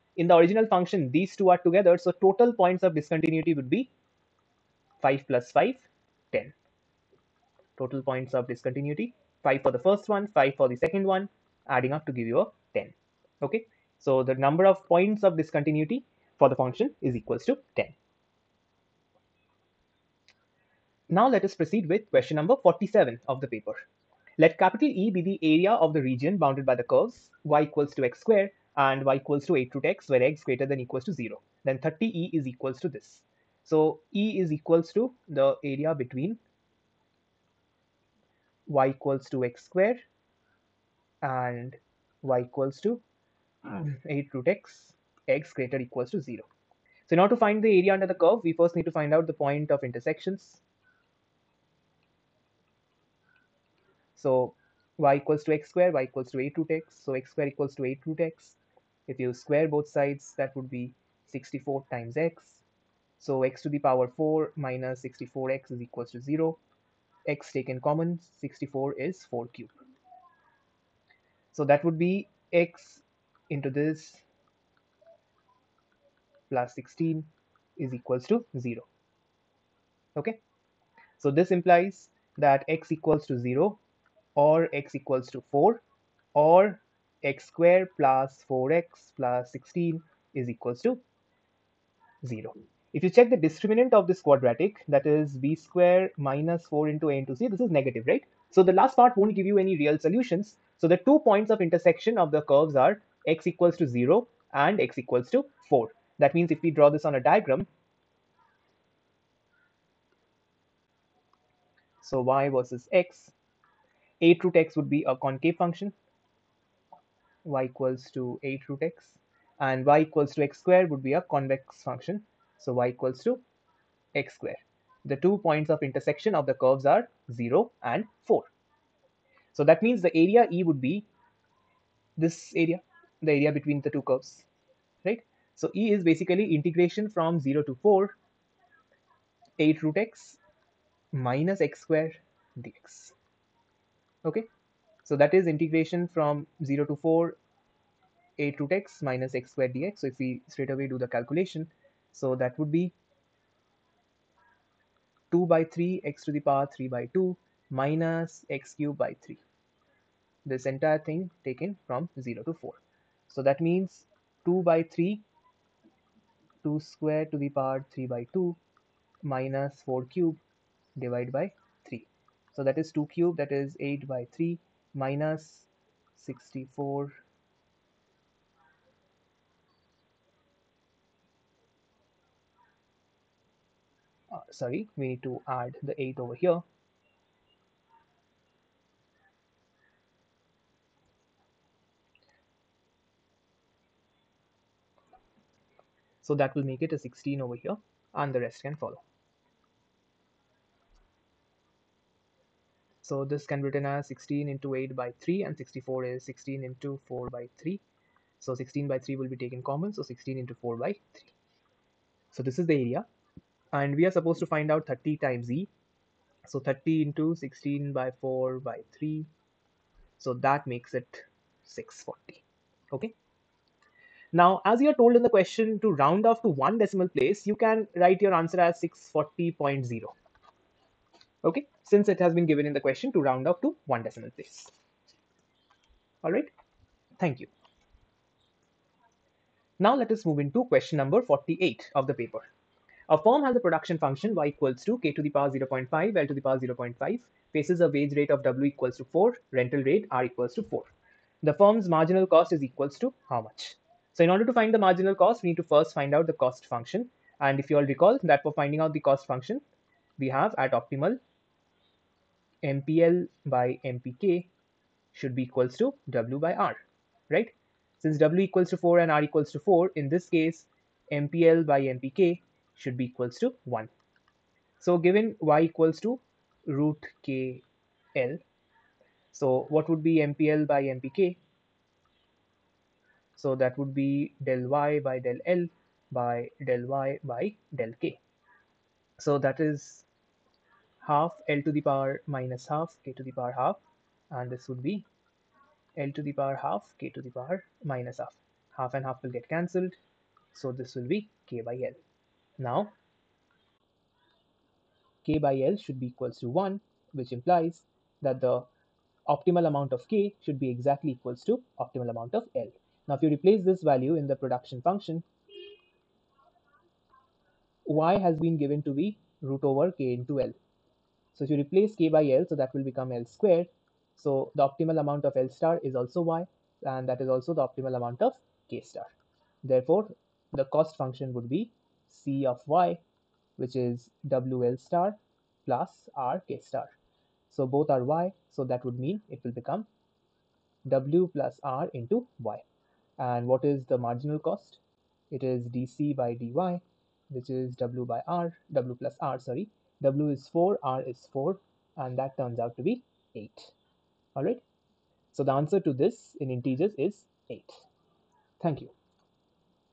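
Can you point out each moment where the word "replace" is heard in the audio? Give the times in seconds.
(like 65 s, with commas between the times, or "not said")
313 s, 321 s.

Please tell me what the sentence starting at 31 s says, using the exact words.
Then 30E is equals to this.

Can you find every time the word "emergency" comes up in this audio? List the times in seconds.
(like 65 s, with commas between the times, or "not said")
not said.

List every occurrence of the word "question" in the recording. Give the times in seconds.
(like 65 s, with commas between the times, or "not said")
22 s, 225 s, 232 s, 240 s.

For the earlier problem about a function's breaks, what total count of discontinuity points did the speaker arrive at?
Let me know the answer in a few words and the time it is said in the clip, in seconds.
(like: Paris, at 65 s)
10, at 6 s.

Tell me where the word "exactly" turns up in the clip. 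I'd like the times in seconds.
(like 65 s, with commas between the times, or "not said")
310 s.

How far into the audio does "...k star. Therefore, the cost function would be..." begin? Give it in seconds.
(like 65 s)
328 s.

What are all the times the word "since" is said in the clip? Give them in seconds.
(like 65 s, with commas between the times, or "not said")
231 s, 267 s.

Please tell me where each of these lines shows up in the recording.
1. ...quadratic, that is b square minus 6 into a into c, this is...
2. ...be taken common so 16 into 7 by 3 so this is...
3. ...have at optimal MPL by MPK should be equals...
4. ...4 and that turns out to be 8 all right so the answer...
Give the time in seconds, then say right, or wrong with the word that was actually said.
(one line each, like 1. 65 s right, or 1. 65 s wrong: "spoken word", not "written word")
1. 94 s wrong: "4", not "6"
2. 209 s wrong: "4", not "7"
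3. 260 s right
4. 351 s right.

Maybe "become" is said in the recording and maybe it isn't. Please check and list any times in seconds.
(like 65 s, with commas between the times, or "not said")
322 s, 339 s.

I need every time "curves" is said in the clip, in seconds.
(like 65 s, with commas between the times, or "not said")
26 s, 48 s, 102 s, 126 s, 134 s.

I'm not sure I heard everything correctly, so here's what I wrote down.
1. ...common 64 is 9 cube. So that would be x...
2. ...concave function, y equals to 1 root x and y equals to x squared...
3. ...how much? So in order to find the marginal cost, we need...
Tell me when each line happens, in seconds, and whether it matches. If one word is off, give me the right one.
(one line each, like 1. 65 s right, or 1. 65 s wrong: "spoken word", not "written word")
1. 67 s wrong: "4", not "9"
2. 115 s wrong: "8", not "1"
3. 253 s right.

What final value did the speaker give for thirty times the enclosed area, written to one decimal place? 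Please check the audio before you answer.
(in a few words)
640.0.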